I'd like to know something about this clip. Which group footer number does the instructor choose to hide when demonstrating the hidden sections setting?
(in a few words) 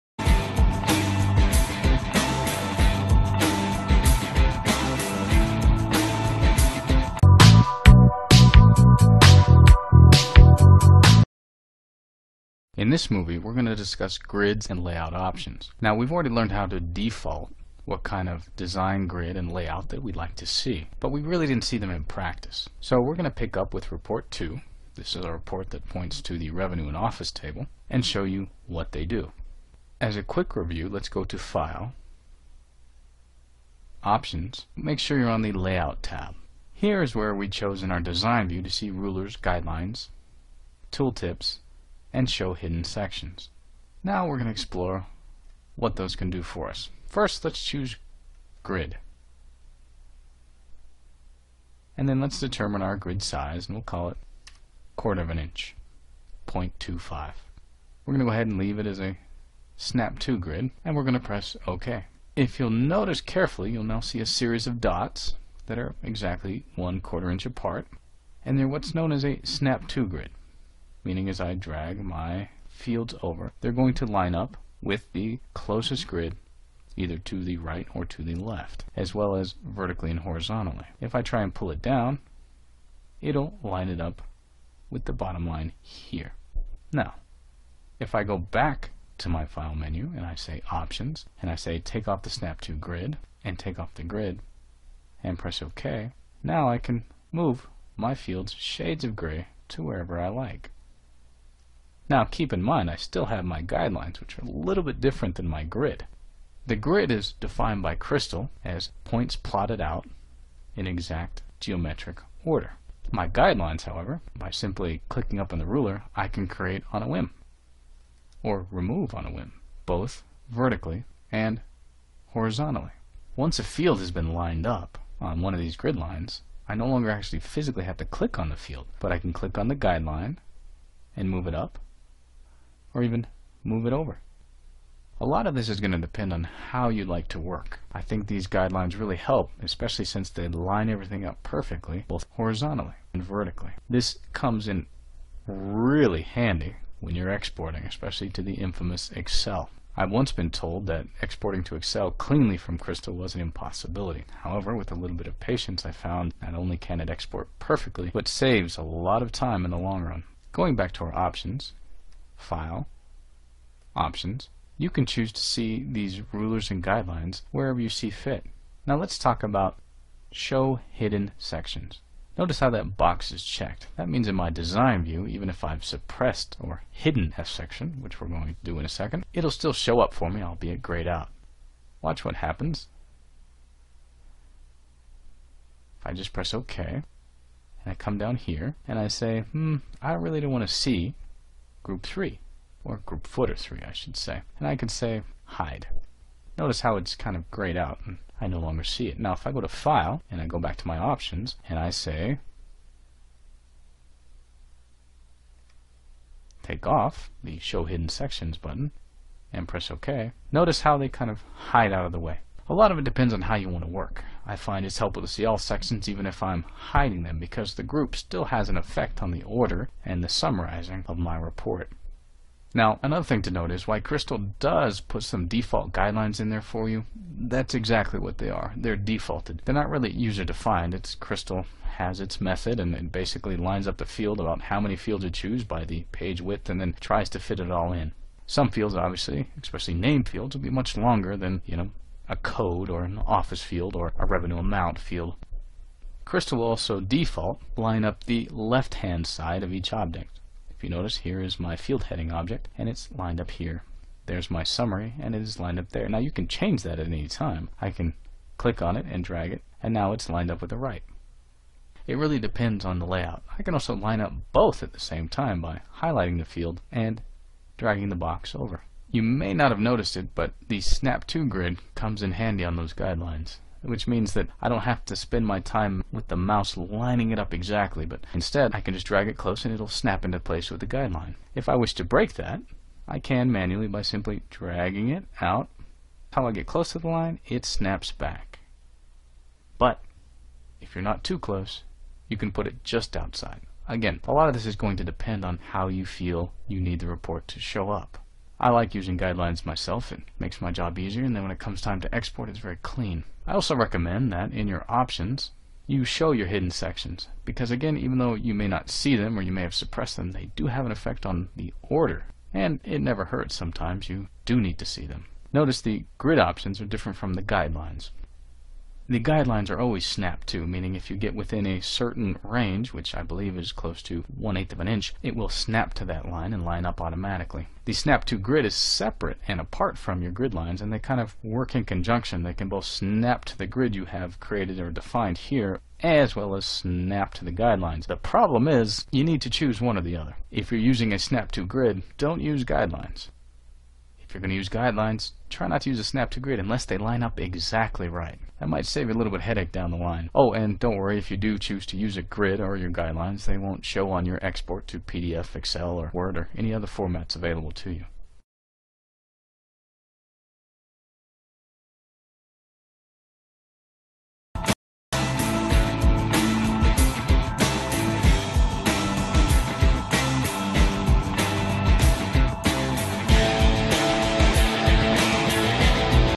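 3.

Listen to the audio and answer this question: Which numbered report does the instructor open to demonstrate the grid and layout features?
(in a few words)
Report 2.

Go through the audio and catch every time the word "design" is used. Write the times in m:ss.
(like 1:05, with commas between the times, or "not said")
0:18, 0:37, 2:54.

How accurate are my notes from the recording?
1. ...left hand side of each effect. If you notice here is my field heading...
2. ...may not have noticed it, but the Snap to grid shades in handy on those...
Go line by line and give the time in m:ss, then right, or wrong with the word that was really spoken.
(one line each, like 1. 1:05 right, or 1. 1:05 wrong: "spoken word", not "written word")
1. 4:08 wrong: "object", not "effect"
2. 4:29 wrong: "comes", not "shades".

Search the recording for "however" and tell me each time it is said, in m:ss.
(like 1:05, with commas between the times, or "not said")
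1:53, 2:34.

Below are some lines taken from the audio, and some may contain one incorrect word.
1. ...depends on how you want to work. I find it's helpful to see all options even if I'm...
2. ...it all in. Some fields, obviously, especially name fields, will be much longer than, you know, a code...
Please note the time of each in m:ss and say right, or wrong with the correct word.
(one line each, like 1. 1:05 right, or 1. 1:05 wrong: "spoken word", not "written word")
1. 3:33 wrong: "sections", not "options"
2. 3:57 right.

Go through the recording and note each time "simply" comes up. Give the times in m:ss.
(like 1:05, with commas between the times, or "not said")
1:54, 4:44.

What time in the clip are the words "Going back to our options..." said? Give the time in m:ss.
2:40.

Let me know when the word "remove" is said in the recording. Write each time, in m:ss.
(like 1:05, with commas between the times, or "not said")
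1:58.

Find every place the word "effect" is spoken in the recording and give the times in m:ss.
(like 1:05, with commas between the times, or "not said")
3:38, 5:10.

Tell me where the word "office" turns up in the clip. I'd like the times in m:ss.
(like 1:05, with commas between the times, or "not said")
0:26, 4:03.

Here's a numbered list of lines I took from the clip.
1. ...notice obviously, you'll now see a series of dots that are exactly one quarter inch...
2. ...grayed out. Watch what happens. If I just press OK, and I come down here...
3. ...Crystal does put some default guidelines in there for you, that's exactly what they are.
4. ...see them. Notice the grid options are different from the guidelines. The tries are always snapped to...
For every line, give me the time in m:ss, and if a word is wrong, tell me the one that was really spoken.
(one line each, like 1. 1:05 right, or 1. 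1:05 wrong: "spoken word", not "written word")
1. 1:02 wrong: "carefully", not "obviously"
2. 3:00 right
3. 3:43 right
4. 5:14 wrong: "guidelines", not "tries".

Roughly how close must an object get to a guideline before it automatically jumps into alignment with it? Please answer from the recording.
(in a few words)
1/8 of an inch.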